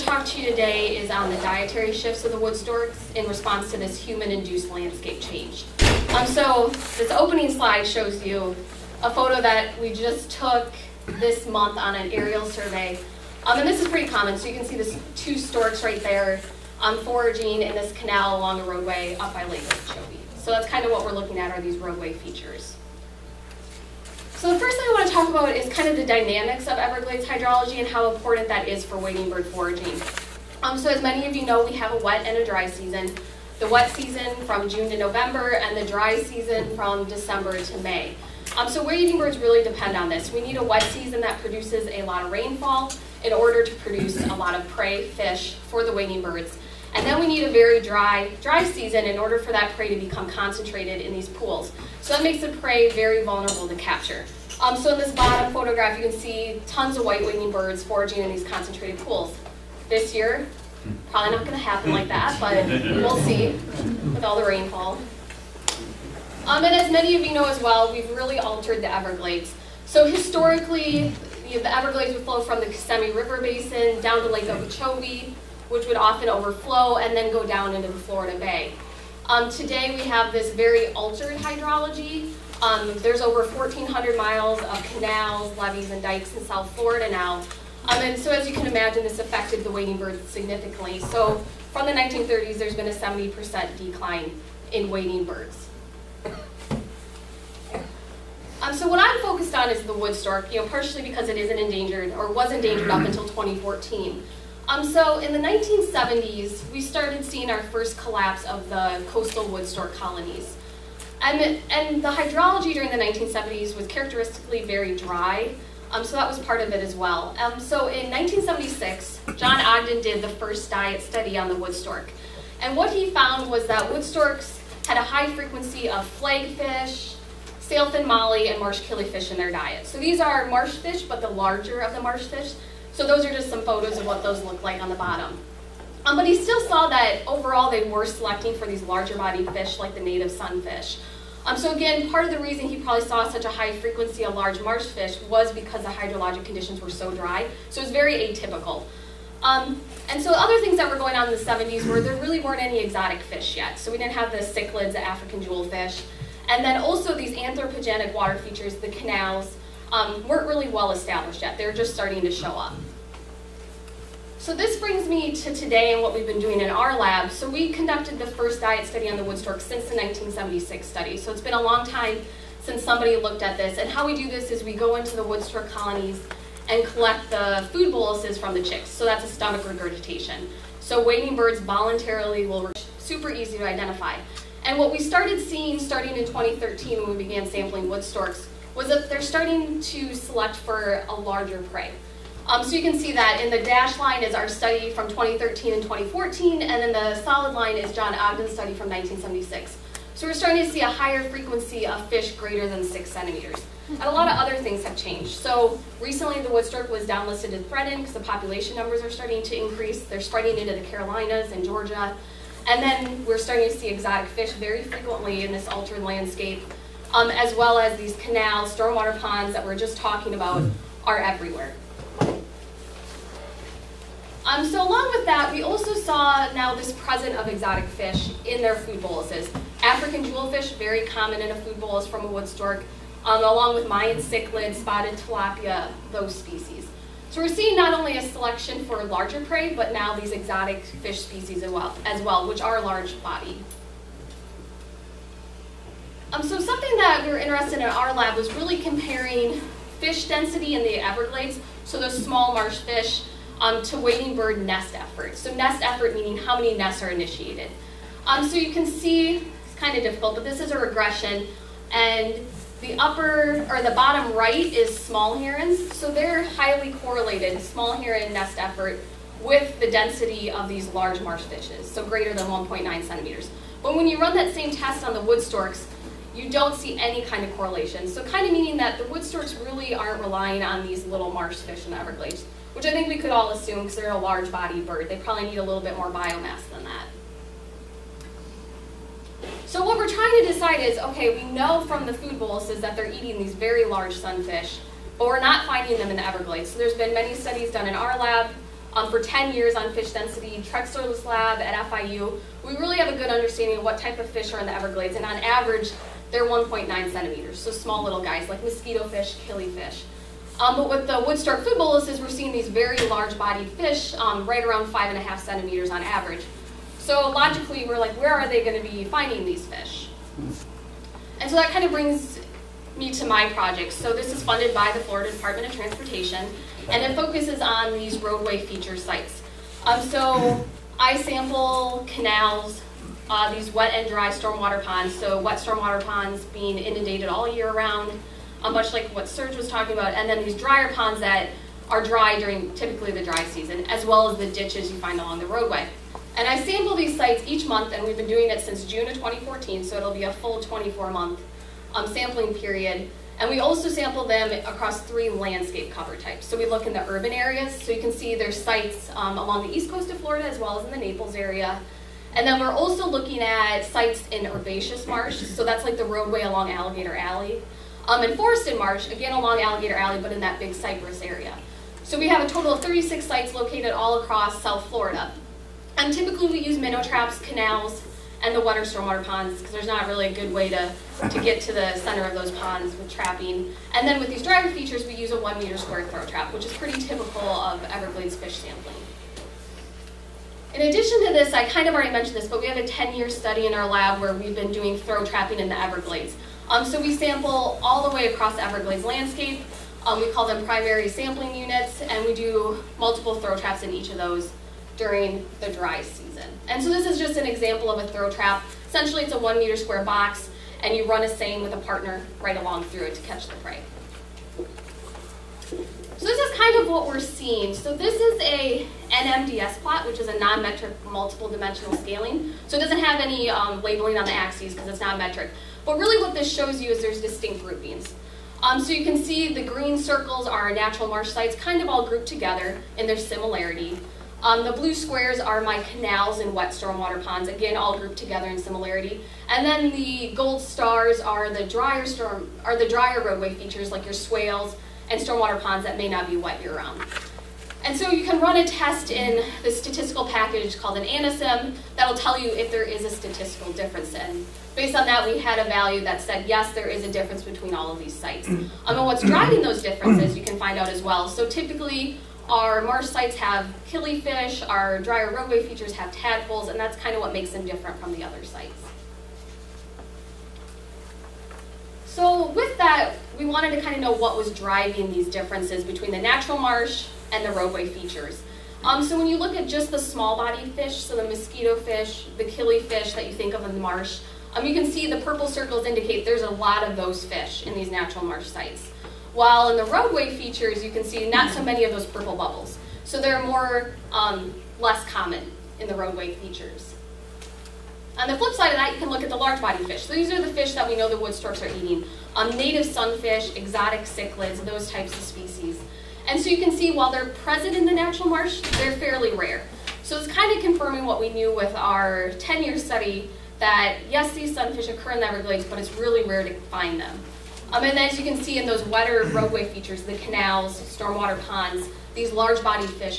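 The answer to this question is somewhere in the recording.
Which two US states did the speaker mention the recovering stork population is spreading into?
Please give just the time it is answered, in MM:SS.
03:30.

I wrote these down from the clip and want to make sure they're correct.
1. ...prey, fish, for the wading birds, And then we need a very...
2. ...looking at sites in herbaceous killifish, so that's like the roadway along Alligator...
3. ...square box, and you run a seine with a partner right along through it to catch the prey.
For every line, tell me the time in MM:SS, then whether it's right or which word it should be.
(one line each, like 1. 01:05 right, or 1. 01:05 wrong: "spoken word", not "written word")
1. 00:44 right
2. 06:03 wrong: "marsh", not "killifish"
3. 06:49 right.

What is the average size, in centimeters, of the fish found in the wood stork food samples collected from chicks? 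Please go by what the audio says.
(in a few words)
5.5 centimeters.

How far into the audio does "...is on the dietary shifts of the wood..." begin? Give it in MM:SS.
00:00.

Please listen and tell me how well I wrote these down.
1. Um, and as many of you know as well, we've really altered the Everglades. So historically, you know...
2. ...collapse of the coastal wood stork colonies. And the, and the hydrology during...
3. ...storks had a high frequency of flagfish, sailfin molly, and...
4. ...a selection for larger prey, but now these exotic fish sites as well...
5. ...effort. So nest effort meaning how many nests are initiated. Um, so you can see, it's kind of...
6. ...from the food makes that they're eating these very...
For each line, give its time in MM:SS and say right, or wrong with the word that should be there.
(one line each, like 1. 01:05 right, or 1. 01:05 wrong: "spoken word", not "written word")
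1. 01:06 right
2. 01:47 right
3. 02:04 right
4. 03:58 wrong: "species", not "sites"
5. 04:14 right
6. 04:51 wrong: "boluses", not "makes".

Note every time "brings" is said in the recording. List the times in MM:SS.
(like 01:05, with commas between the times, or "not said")
02:44, 05:21.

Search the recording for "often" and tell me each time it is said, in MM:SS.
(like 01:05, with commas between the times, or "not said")
01:15.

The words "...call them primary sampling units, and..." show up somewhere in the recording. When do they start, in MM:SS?
06:40.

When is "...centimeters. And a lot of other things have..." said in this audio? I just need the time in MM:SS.
03:23.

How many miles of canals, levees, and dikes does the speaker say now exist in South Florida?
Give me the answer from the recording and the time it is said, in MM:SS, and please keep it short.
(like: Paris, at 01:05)
1,400, at 01:23.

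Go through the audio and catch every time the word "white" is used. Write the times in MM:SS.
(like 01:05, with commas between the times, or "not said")
00:57.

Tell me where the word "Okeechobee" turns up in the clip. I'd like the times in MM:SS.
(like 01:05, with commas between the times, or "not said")
00:19, 01:14.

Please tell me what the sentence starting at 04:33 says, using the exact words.
But when you run that same test on the wood storks, you don't see any kind of correlation.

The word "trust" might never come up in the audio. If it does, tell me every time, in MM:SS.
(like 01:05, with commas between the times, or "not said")
not said.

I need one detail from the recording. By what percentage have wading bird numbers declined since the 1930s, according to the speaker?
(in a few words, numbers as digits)
70%.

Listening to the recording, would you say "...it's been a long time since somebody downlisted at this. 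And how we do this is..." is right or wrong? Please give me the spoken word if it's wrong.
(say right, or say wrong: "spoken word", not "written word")
wrong: "looked", not "downlisted".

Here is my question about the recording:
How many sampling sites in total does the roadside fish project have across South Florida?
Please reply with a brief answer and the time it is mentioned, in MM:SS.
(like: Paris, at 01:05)
36, at 06:12.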